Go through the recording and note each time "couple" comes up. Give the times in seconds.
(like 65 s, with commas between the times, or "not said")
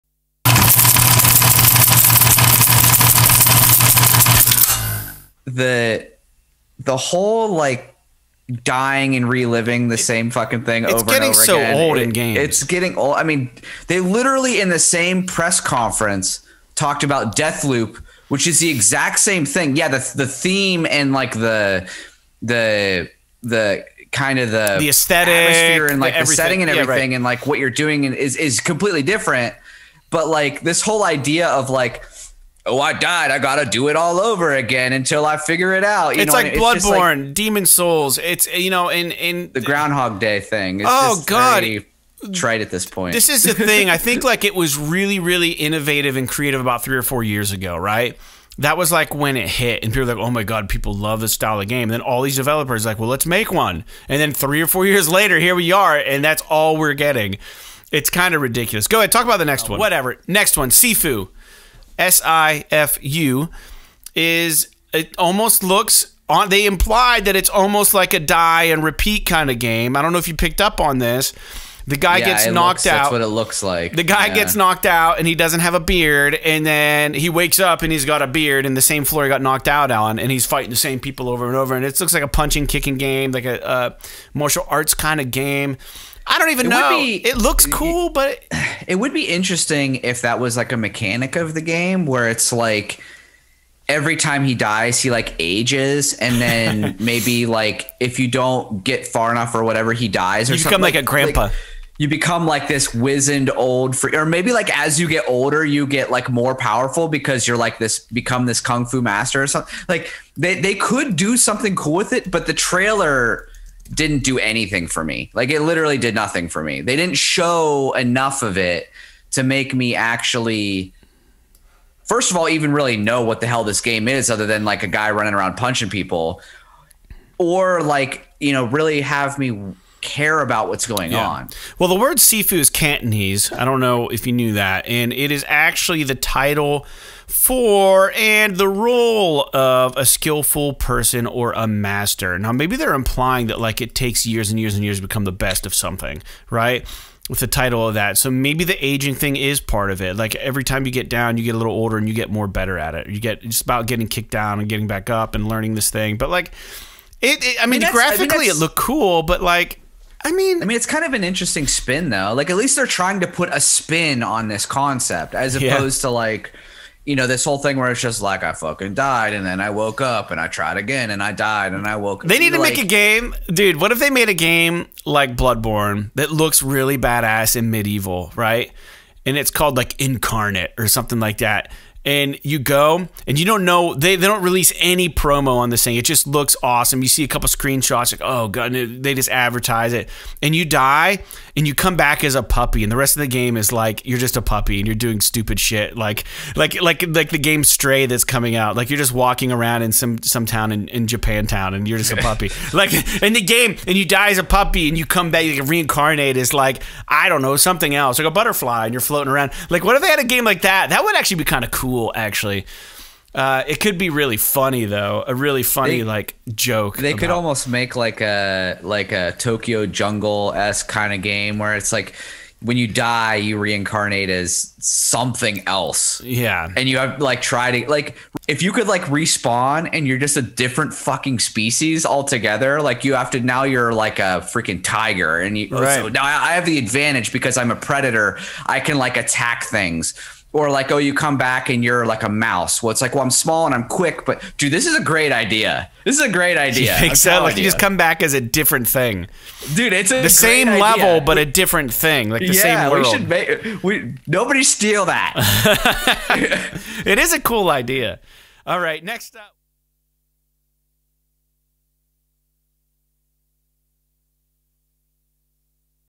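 187 s.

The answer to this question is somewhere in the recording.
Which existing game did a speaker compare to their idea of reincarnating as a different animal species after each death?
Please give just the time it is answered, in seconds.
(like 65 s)
219 s.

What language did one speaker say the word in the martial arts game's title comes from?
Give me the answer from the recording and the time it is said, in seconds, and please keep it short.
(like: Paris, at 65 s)
Cantonese, at 132 s.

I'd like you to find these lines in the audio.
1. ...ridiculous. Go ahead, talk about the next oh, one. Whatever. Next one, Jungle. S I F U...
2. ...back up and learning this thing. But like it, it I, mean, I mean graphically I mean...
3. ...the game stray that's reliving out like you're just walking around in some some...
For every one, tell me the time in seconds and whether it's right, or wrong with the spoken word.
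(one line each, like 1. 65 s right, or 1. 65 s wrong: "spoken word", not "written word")
1. 58 s wrong: "Sifu", not "Jungle"
2. 154 s right
3. 197 s wrong: "coming", not "reliving".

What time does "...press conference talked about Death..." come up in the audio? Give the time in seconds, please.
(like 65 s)
15 s.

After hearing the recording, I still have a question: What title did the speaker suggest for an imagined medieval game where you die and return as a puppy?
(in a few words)
Incarnate.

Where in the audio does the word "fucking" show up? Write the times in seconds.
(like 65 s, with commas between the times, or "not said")
10 s, 168 s, 230 s.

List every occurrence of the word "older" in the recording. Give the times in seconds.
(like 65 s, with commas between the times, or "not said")
105 s, 151 s.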